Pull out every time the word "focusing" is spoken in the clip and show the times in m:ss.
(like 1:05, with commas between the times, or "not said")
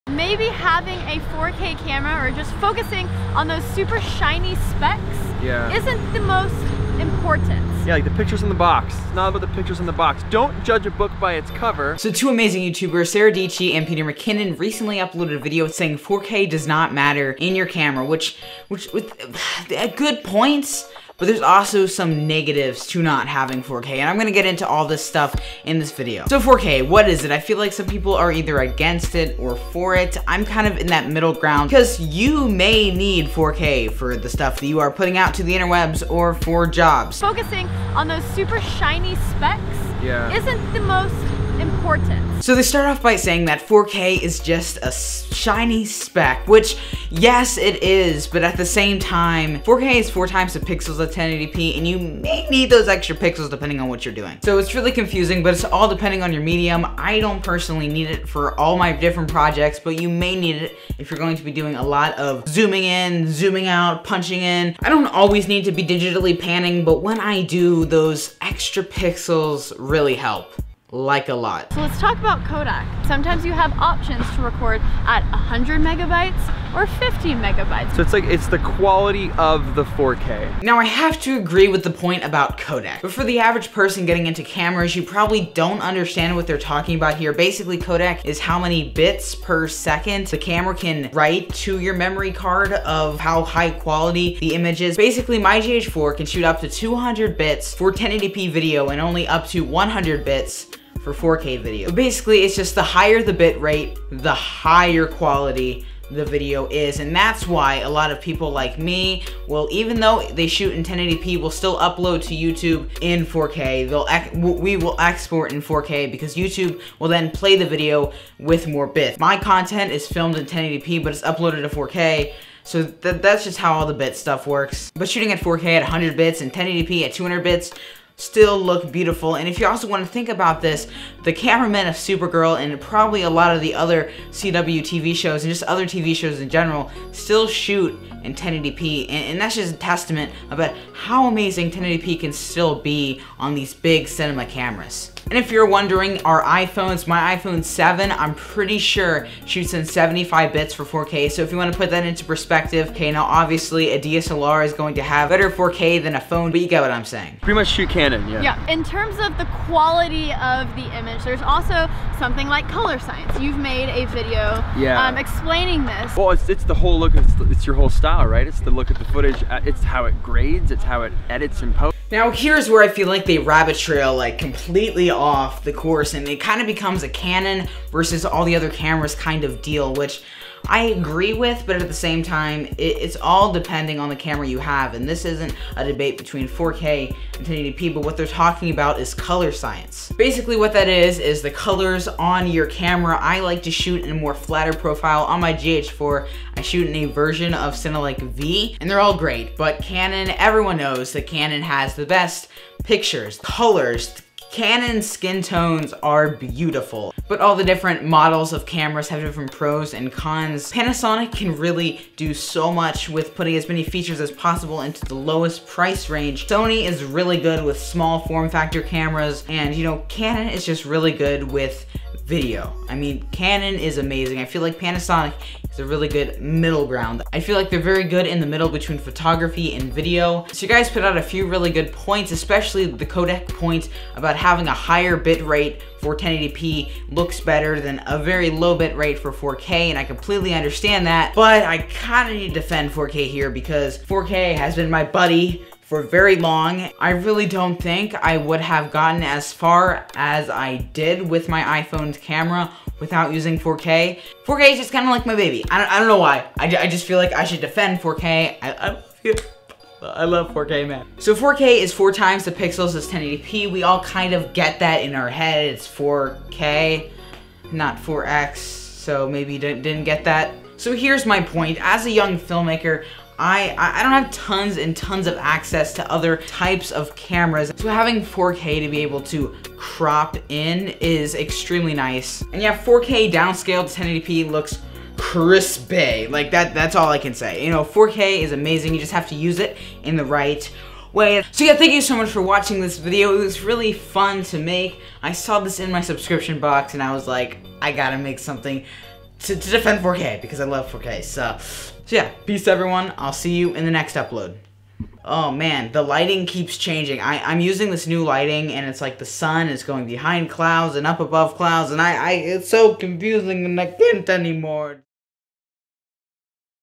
0:02, 0:37.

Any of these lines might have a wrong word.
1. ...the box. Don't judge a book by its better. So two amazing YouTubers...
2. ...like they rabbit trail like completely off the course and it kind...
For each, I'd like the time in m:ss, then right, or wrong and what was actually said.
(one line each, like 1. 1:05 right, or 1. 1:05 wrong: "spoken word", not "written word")
1. 0:09 wrong: "cover", not "better"
2. 2:53 right.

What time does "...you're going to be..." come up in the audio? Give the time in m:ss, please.
1:01.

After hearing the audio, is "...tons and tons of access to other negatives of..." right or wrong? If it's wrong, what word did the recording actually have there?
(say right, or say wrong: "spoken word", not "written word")
wrong: "types", not "negatives".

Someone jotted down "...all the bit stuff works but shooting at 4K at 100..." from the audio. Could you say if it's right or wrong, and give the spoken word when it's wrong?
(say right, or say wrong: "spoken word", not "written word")
right.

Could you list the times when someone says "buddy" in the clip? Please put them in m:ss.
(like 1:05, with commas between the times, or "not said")
4:05.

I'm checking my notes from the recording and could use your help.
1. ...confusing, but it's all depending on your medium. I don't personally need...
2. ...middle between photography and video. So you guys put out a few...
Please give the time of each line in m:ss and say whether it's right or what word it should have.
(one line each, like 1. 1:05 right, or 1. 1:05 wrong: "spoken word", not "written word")
1. 0:54 right
2. 3:48 right.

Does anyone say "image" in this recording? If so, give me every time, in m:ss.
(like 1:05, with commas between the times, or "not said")
1:34, 2:40.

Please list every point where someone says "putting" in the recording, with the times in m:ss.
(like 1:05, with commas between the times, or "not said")
0:34, 3:33.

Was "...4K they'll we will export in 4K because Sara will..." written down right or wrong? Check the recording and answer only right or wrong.
wrong.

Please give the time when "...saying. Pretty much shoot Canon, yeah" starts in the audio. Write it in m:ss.
2:37.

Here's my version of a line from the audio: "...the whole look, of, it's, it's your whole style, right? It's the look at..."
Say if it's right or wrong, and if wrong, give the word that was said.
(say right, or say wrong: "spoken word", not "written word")
right.